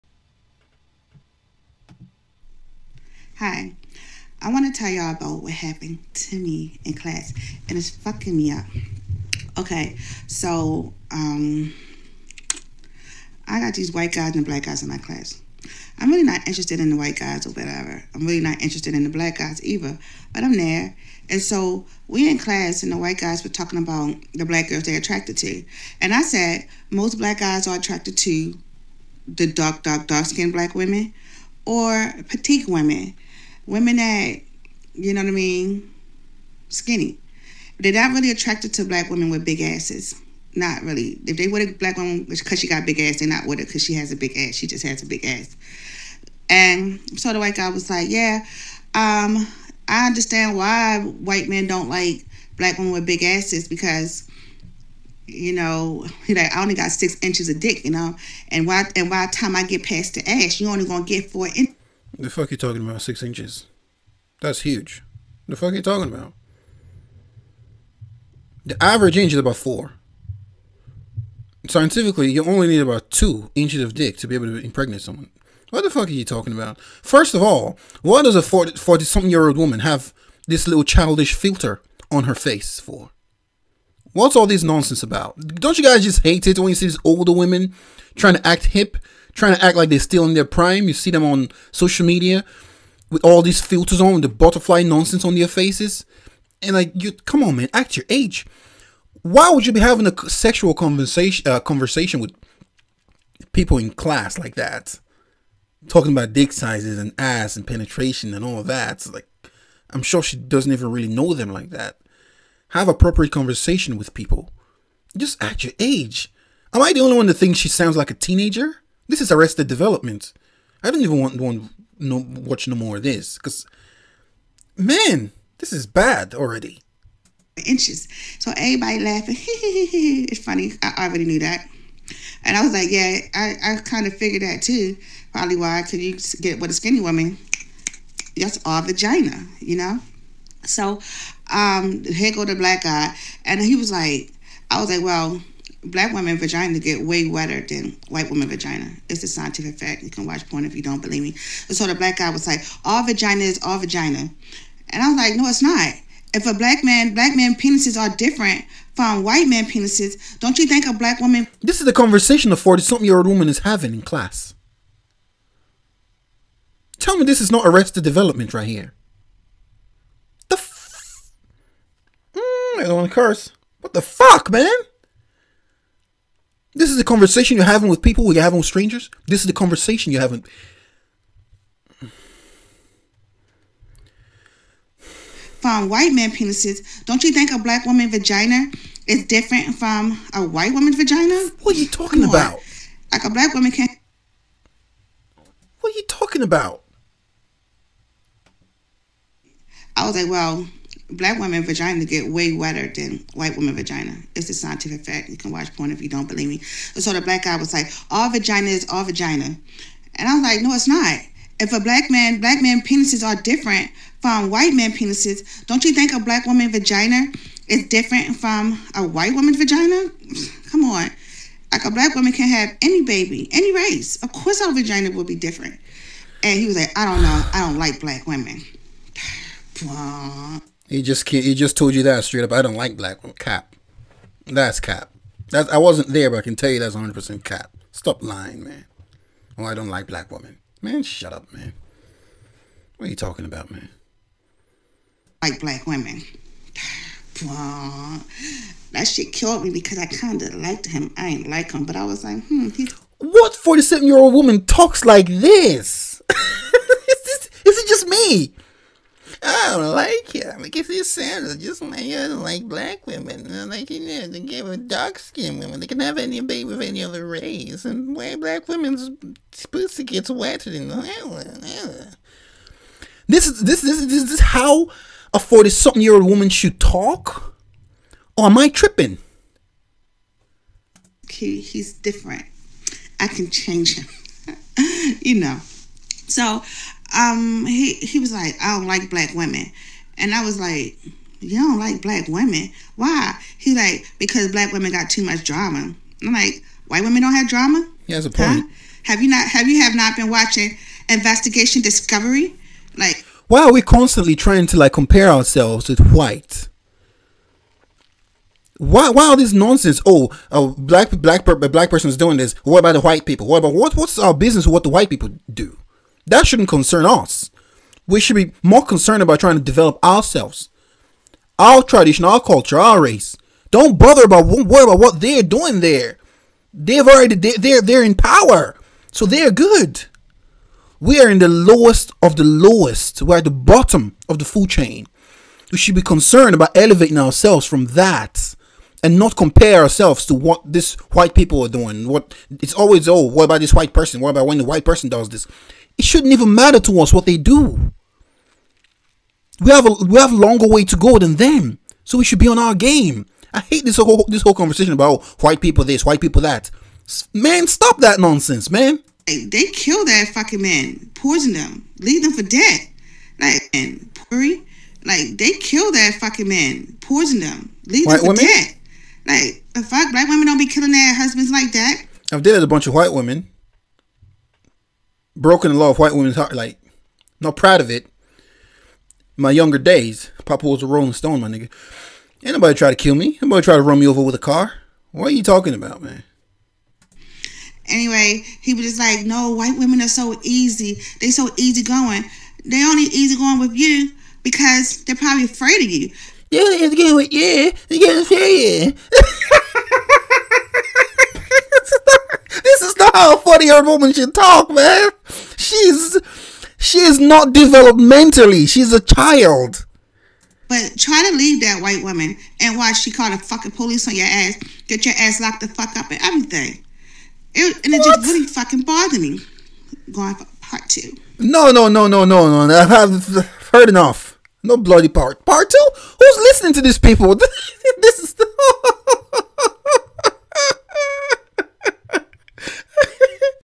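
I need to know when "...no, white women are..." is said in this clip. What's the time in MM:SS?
06:29.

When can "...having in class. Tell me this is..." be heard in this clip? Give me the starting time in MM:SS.
02:43.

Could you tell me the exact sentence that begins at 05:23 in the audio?
Don't bother about worry about what they're doing there.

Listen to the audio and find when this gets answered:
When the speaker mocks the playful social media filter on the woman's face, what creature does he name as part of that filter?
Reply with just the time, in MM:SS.
01:34.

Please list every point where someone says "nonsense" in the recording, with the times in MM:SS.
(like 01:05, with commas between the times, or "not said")
01:24, 01:34, 05:09, 05:58.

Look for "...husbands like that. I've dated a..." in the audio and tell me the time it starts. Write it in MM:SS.
06:11.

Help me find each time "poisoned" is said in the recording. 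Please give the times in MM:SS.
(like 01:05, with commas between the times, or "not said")
06:01, 06:07.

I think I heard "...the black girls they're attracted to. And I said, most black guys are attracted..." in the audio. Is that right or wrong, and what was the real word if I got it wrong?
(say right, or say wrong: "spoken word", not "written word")
right.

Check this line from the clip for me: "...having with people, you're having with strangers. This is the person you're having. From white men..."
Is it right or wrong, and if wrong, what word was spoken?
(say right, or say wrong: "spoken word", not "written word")
wrong: "conversation", not "person".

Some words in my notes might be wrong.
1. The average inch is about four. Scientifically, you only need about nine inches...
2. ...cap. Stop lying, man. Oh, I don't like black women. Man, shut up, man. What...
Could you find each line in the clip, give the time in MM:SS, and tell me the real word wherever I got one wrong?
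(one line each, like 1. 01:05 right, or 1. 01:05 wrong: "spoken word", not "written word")
1. 01:08 wrong: "two", not "nine"
2. 03:57 right.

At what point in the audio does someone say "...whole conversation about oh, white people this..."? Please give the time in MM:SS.
05:54.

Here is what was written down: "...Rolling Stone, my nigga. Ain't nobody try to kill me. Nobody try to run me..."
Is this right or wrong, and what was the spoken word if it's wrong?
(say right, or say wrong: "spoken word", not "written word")
right.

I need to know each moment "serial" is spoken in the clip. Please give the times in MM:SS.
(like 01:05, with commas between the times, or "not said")
not said.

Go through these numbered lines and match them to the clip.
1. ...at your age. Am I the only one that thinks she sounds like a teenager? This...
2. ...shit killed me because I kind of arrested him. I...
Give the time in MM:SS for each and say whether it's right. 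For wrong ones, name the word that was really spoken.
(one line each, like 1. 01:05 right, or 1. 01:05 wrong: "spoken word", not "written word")
1. 01:55 right
2. 04:09 wrong: "liked", not "arrested".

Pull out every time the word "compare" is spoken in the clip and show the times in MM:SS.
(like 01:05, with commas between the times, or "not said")
05:04, 05:39.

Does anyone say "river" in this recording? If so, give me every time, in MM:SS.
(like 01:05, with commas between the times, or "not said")
not said.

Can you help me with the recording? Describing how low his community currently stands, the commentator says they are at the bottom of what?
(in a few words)
the food chain.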